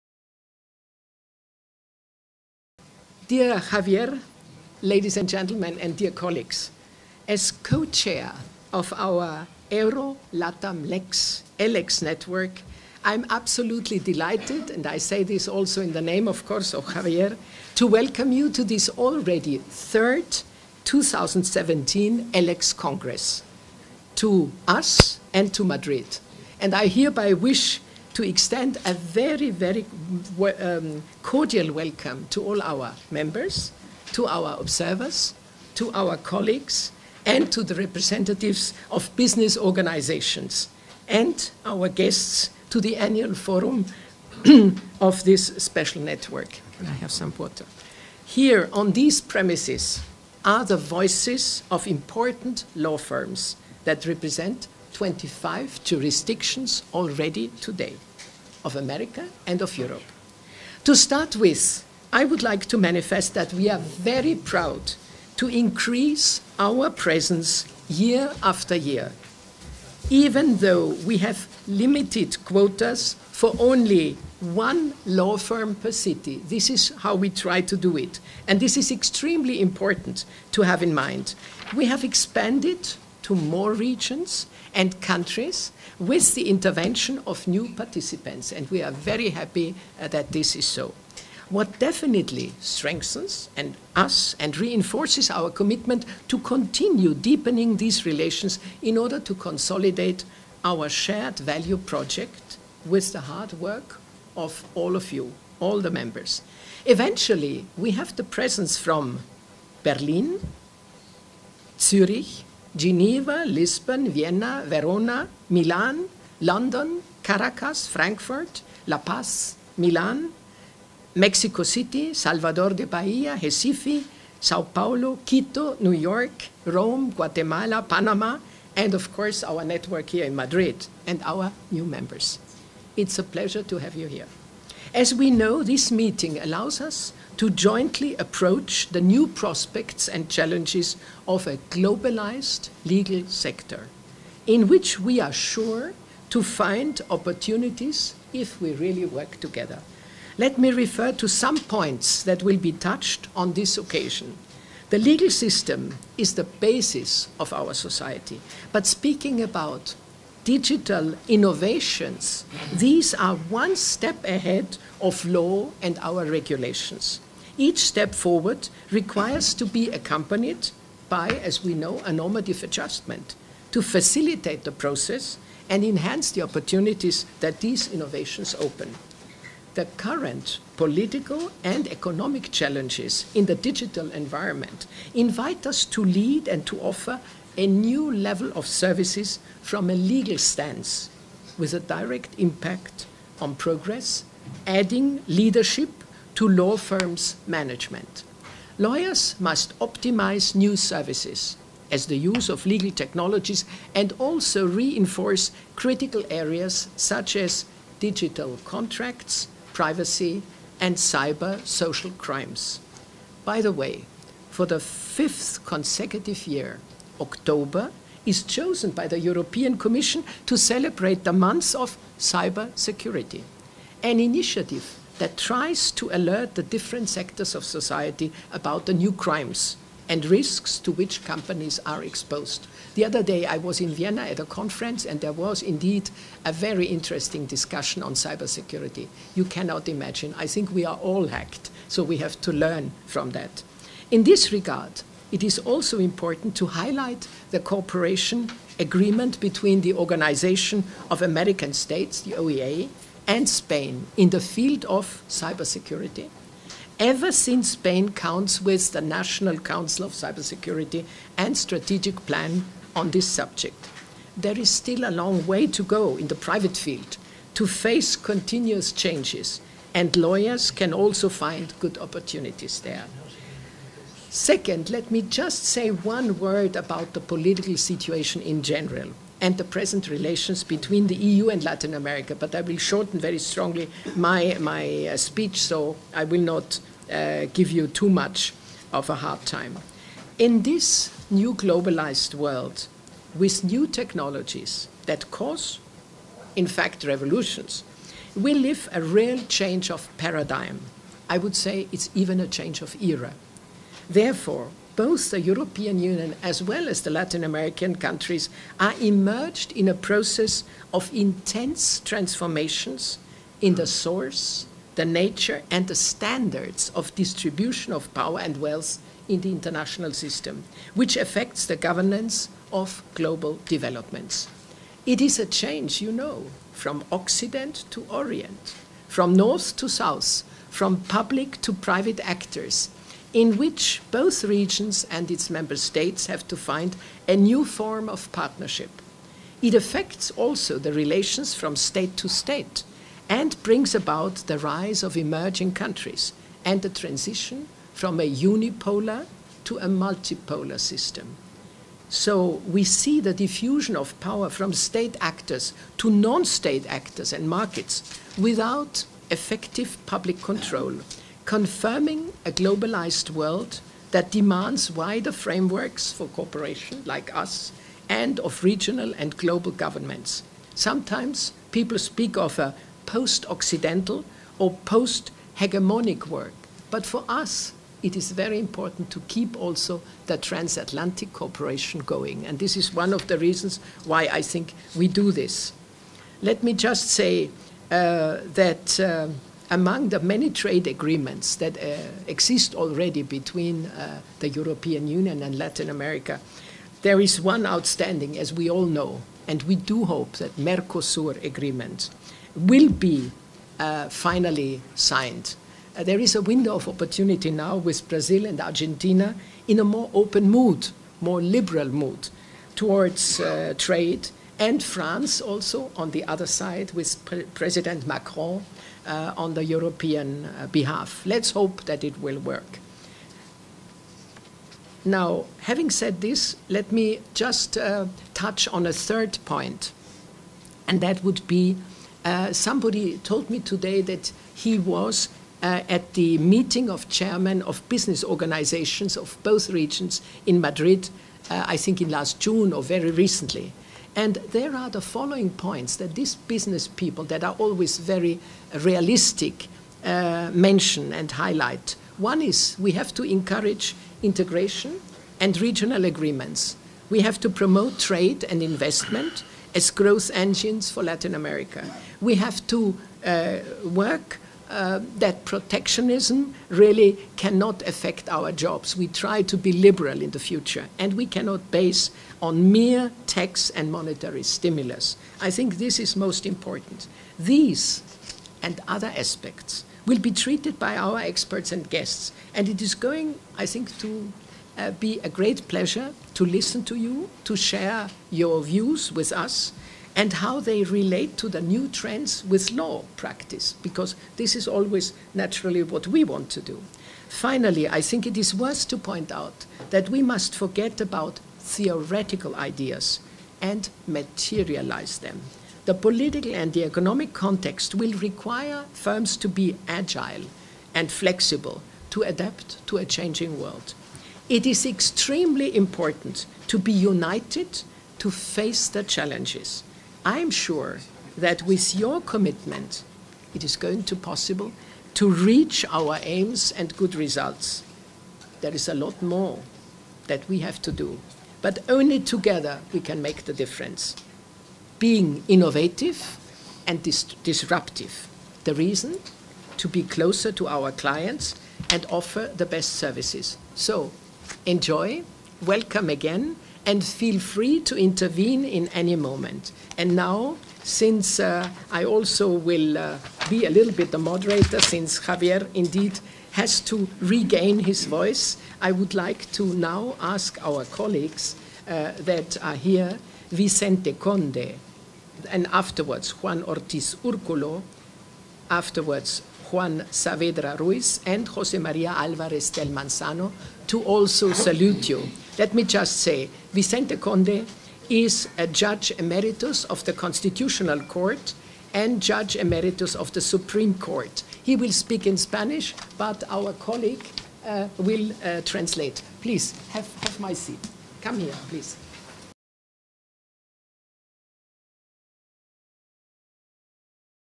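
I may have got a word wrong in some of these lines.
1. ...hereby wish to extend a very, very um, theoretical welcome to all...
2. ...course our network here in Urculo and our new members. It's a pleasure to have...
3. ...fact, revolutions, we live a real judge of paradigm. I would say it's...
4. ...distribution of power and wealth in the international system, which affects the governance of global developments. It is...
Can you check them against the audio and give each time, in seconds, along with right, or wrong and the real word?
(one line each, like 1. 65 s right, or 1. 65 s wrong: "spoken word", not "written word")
1. 26 s wrong: "cordial", not "theoretical"
2. 129 s wrong: "Madrid", not "Urculo"
3. 296 s wrong: "change", not "judge"
4. 317 s right.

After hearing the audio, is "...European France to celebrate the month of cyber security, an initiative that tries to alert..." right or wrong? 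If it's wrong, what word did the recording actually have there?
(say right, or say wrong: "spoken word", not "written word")
wrong: "Commission", not "France".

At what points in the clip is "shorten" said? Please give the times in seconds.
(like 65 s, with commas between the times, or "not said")
282 s.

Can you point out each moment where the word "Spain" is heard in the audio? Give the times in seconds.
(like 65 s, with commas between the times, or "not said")
253 s, 257 s.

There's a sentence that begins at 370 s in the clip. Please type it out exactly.
Sometimes people speak of a post Occidental or post hegemonic work.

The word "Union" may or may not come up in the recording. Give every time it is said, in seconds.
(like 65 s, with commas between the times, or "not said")
305 s, 395 s.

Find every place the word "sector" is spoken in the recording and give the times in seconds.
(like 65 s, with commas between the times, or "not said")
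143 s, 227 s.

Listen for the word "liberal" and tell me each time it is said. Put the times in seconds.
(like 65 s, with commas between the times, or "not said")
411 s, 469 s.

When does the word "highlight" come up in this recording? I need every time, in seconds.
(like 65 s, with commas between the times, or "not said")
246 s, 451 s.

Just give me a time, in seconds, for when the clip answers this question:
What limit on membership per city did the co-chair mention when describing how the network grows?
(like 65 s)
74 s.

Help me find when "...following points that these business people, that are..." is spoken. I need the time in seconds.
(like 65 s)
445 s.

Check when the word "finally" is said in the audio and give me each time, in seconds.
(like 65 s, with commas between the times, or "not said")
404 s, 497 s.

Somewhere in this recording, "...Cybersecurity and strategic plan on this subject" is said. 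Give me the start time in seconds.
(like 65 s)
260 s.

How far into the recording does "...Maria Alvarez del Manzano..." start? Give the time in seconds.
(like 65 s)
571 s.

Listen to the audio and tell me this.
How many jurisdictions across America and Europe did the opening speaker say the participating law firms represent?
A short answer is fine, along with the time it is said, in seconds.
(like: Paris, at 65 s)
25, at 54 s.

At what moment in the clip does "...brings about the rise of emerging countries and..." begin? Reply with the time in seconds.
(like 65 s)
343 s.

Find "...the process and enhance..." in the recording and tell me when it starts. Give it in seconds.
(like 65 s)
174 s.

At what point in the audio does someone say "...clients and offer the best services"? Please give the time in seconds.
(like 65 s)
540 s.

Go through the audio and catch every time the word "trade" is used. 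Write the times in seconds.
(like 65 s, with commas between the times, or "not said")
390 s, 413 s, 457 s.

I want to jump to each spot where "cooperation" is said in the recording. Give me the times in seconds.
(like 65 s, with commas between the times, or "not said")
247 s, 366 s, 381 s.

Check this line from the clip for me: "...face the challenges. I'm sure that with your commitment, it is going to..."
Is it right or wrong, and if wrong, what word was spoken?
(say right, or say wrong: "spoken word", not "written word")
right.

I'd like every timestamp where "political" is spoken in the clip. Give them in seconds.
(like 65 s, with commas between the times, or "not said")
180 s, 277 s, 505 s.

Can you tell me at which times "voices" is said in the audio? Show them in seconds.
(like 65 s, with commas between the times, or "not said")
50 s, 558 s.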